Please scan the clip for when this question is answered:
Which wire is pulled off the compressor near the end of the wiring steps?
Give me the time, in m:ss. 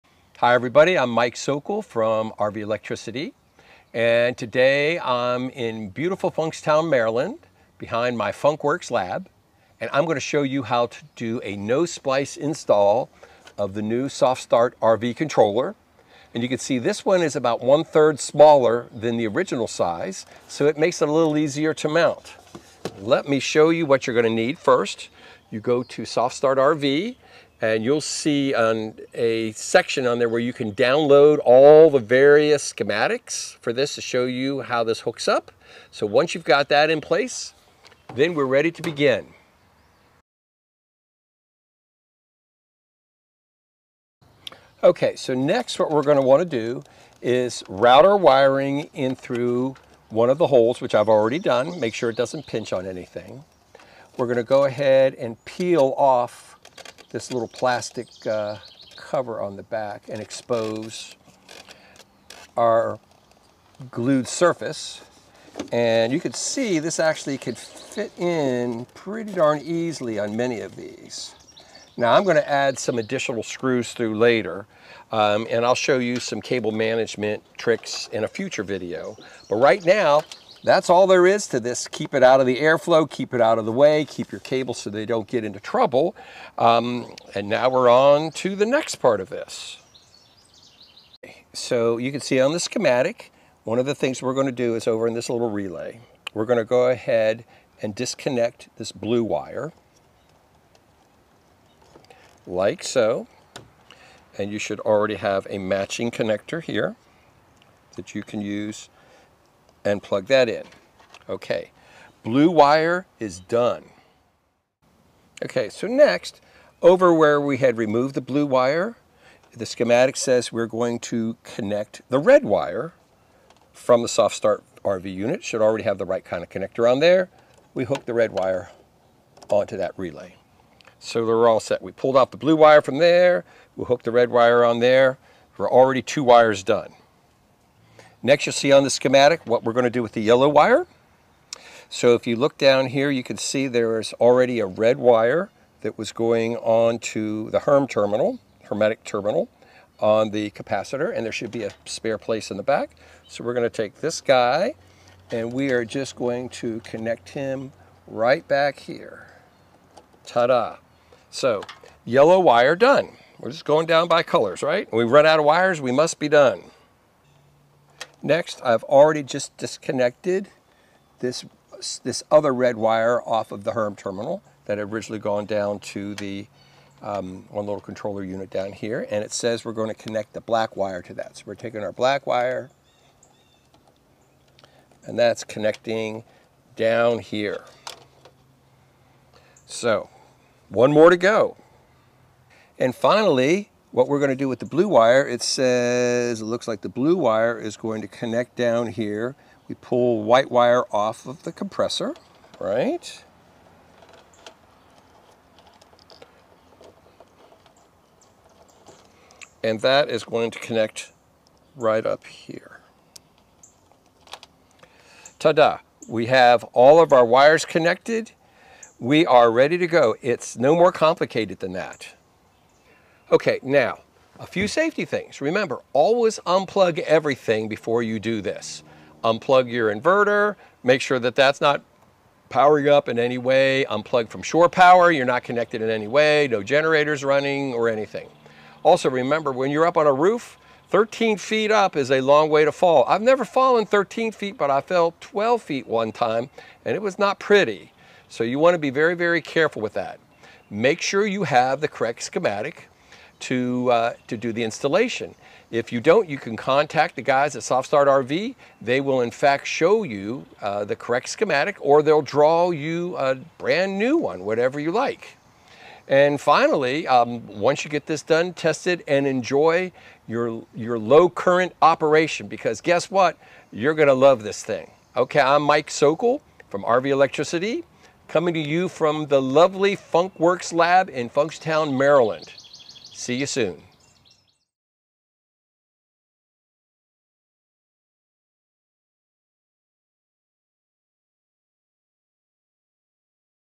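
3:20.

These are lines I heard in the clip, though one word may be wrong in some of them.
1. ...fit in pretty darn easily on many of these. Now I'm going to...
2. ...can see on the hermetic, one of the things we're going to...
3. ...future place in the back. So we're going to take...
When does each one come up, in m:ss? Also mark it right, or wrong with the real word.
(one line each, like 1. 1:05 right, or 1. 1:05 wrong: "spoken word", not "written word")
1. 1:07 right
2. 1:32 wrong: "schematic", not "hermetic"
3. 2:31 wrong: "spare", not "future".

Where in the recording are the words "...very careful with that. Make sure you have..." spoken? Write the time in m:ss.
4:09.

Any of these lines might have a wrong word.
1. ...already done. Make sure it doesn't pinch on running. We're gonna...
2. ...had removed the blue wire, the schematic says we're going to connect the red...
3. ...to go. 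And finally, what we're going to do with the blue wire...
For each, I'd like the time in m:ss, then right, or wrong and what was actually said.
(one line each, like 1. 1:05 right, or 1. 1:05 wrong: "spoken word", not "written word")
1. 0:51 wrong: "anything", not "running"
2. 1:57 right
3. 3:11 right.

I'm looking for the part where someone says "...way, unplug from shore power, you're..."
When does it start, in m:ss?
3:53.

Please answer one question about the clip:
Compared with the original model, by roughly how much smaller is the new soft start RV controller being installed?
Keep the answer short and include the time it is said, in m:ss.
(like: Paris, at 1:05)
one third, at 0:17.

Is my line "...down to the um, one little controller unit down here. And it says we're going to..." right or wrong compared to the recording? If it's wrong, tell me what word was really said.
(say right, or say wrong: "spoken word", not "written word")
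right.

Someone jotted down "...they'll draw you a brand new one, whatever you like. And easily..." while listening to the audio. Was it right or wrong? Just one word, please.
wrong.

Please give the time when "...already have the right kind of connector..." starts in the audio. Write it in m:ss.
2:05.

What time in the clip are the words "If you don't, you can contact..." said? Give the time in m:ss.
4:15.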